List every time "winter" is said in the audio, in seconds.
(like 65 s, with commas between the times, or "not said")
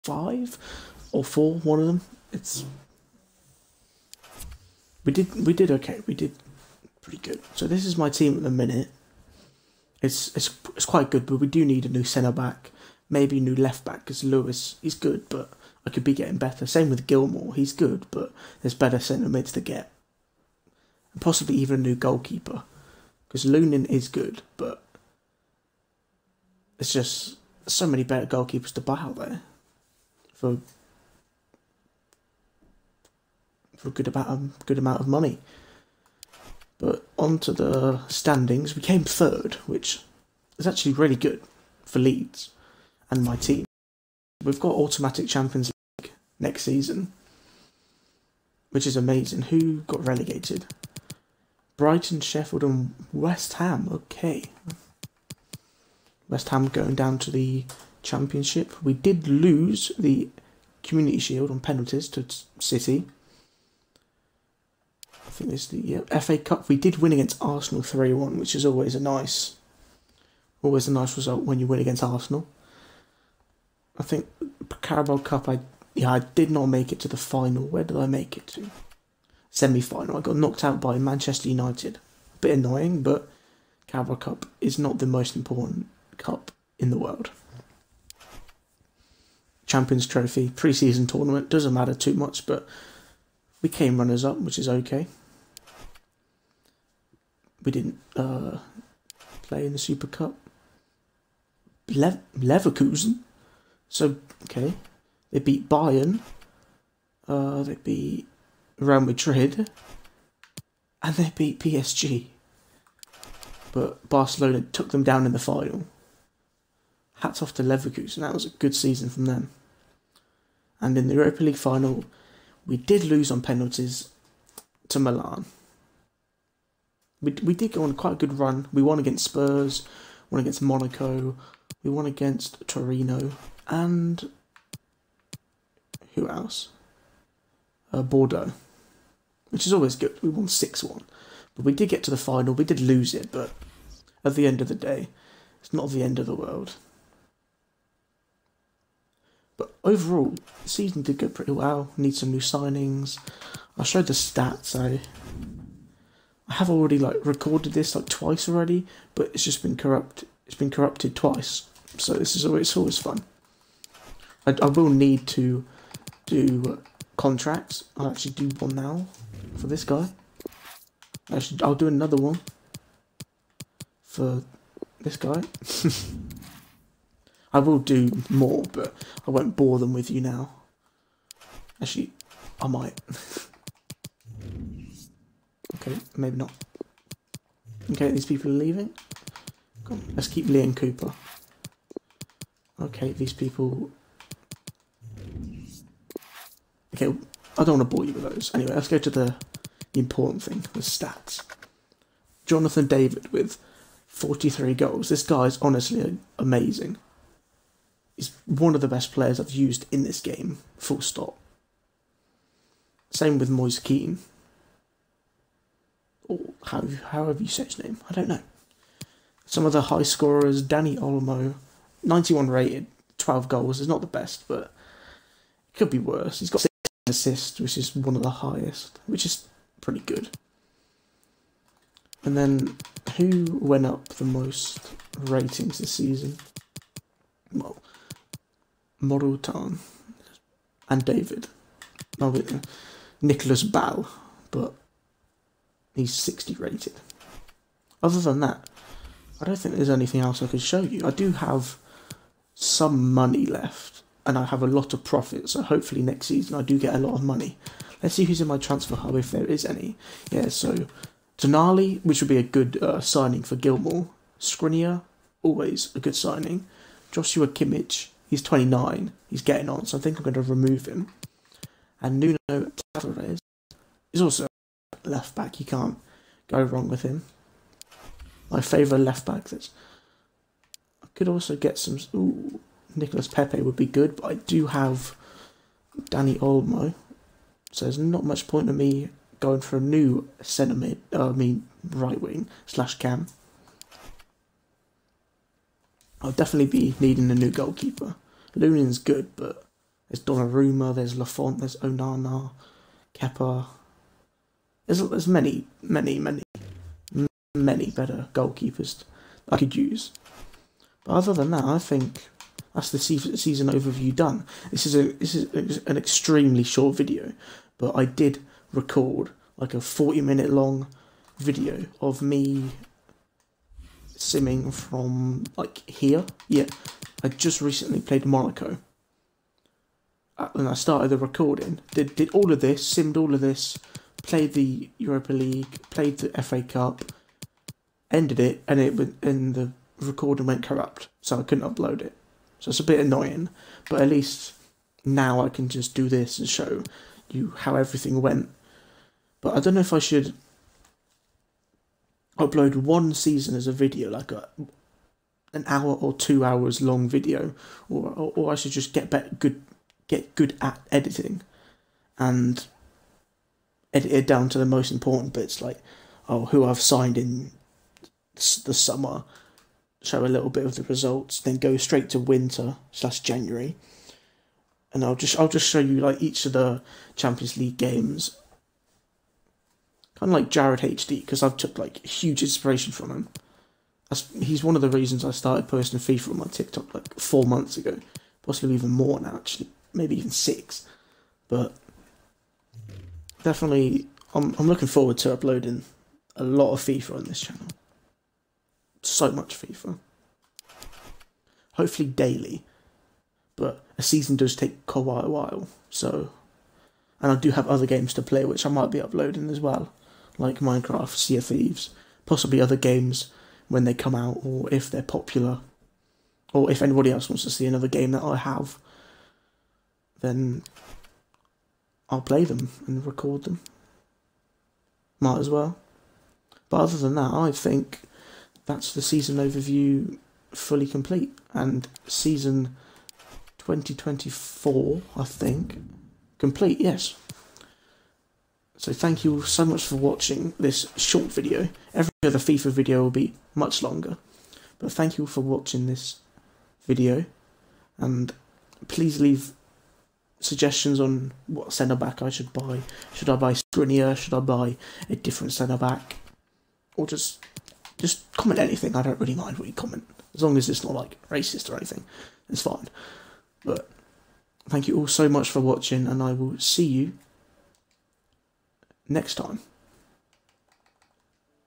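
372 s.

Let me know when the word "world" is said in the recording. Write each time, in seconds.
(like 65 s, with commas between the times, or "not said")
86 s, 146 s.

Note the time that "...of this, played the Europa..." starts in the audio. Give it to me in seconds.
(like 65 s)
333 s.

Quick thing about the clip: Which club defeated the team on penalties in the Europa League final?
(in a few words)
Milan.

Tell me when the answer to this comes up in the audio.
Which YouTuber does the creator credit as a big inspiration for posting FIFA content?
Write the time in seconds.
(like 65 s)
380 s.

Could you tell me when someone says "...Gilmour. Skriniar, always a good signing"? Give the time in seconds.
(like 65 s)
263 s.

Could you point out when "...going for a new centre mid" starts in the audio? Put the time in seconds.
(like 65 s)
289 s.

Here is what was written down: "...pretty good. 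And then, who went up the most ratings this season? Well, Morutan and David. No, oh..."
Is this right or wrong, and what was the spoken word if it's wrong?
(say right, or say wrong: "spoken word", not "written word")
right.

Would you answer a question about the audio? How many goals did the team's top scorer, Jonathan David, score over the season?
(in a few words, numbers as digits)
43.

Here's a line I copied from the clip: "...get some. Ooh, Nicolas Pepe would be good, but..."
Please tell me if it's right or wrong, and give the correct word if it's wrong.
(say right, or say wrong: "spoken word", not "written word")
right.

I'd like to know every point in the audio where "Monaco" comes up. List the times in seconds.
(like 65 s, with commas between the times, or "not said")
130 s, 328 s.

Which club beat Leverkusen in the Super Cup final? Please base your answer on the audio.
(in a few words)
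Barcelona.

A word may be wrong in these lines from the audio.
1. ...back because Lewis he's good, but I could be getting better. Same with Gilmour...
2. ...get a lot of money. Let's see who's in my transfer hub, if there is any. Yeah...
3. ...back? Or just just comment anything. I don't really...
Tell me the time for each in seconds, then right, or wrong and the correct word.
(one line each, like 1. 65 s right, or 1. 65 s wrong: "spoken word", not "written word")
1. 13 s right
2. 256 s right
3. 455 s right.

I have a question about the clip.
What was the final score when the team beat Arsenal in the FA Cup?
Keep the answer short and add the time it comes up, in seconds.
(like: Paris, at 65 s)
3-1, at 67 s.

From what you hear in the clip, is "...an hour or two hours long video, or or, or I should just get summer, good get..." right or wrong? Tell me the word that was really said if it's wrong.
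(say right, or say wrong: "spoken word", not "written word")
wrong: "better", not "summer".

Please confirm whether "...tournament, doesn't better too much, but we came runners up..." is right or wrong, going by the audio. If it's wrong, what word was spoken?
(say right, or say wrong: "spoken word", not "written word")
wrong: "matter", not "better".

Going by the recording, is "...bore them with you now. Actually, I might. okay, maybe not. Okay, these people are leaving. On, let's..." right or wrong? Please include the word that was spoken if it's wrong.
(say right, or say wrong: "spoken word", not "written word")
right.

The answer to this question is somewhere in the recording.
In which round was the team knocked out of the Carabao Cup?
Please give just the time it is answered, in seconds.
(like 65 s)
79 s.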